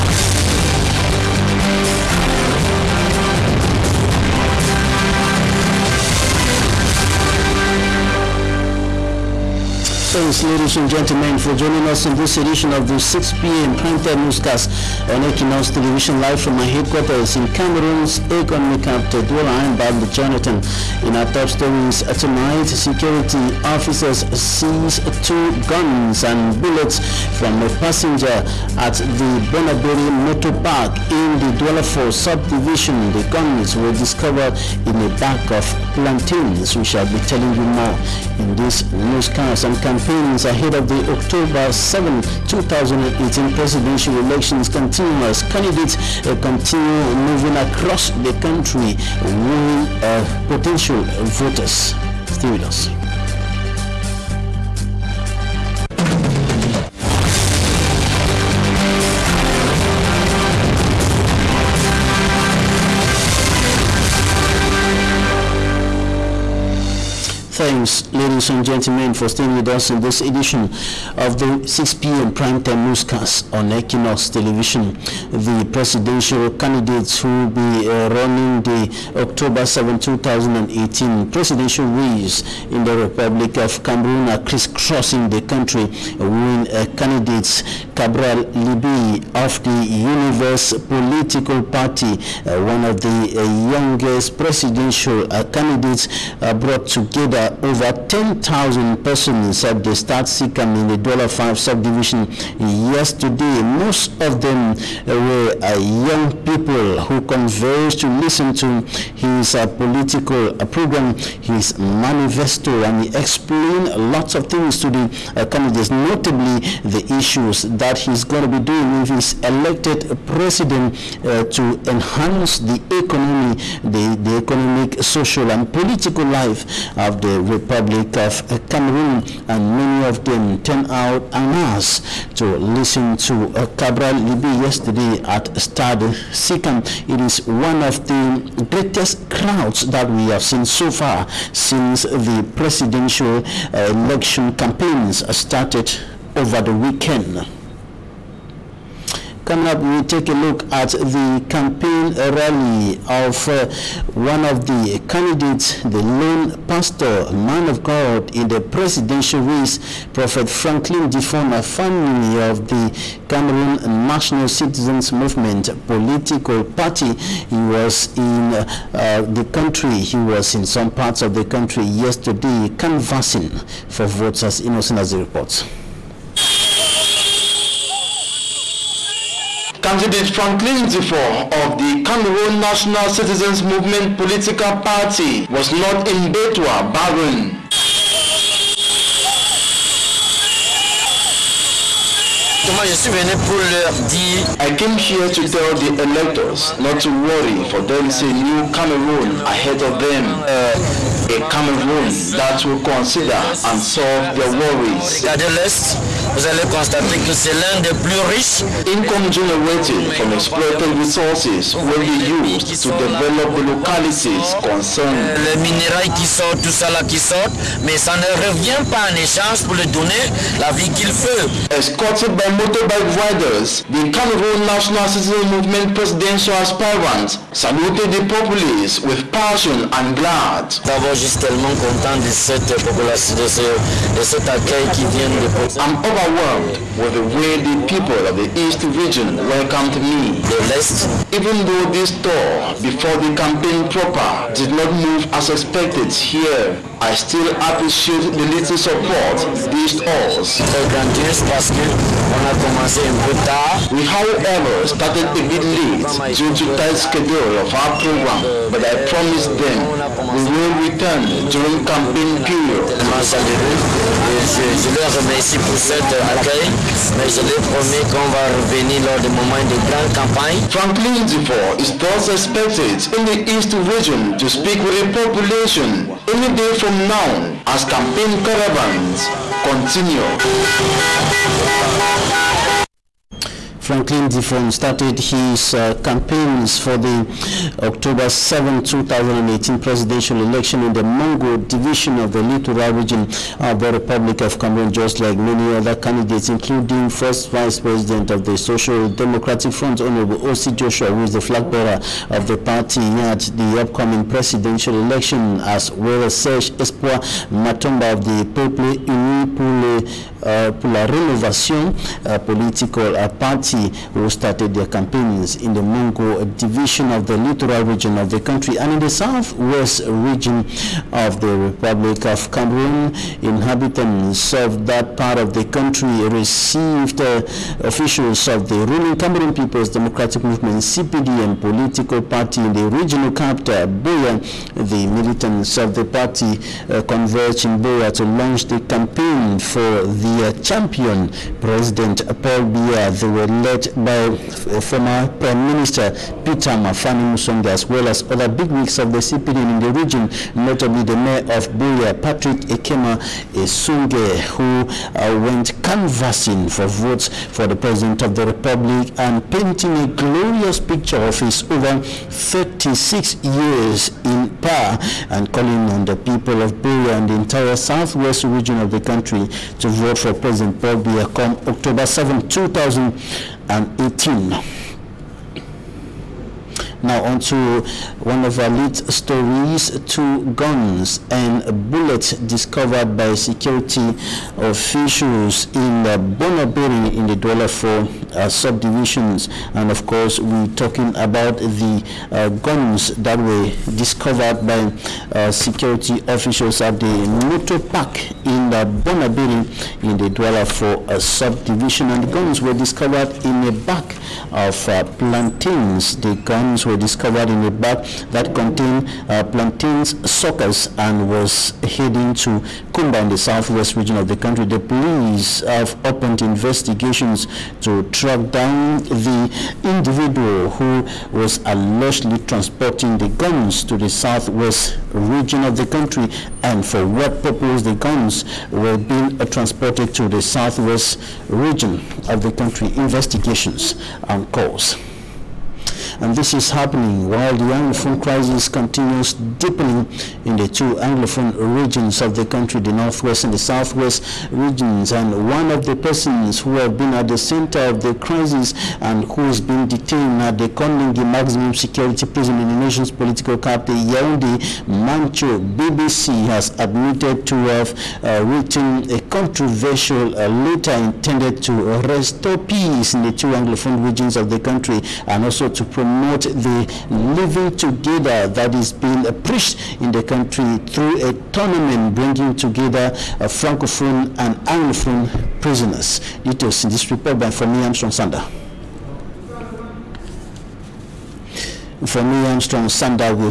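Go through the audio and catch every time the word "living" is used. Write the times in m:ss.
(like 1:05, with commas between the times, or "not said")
7:47.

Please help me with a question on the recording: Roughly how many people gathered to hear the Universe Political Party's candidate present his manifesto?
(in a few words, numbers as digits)
over 10,000.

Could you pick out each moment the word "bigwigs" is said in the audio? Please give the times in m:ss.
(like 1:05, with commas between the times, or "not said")
5:48.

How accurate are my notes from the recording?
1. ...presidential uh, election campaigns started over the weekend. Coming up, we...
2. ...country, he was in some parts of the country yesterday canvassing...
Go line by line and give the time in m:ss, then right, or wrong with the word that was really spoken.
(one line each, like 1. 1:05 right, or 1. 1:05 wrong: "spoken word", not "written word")
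1. 2:22 right
2. 2:49 right.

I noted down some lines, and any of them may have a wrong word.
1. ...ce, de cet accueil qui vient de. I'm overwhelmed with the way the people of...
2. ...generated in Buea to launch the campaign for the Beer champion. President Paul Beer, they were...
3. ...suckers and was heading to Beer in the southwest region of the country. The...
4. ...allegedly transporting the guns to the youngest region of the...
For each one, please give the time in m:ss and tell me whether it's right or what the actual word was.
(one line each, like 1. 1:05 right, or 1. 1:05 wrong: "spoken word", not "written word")
1. 3:53 right
2. 5:37 wrong: "converged", not "generated"
3. 6:50 wrong: "Kumba", not "Beer"
4. 7:01 wrong: "southwest", not "youngest".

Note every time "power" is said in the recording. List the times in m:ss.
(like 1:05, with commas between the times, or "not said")
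6:04.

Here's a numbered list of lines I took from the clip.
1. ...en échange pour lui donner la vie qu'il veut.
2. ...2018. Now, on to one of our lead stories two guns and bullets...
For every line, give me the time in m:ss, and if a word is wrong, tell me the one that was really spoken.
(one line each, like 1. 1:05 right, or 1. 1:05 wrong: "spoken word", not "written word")
1. 3:39 right
2. 6:12 right.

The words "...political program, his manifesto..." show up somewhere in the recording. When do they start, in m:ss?
1:49.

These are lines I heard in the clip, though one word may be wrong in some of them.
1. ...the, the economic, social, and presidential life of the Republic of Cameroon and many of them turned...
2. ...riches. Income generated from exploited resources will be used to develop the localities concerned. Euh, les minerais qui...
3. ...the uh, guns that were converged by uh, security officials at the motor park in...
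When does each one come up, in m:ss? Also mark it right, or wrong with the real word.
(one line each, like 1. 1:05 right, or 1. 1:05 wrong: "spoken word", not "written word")
1. 2:03 wrong: "political", not "presidential"
2. 3:28 right
3. 6:31 wrong: "discovered", not "converged".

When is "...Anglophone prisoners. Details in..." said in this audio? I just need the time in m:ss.
7:54.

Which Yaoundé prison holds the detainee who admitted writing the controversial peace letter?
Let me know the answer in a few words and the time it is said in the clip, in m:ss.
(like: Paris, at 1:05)
Kondengui Maximum Security Prison, at 7:30.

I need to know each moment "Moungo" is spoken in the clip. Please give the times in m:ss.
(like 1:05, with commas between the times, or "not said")
4:51, 5:15.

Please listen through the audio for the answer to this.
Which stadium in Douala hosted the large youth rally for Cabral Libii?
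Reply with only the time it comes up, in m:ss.
2:15.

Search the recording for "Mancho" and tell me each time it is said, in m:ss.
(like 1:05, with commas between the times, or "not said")
7:34.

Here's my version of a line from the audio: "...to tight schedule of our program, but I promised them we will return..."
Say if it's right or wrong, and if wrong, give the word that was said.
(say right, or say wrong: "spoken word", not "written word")
right.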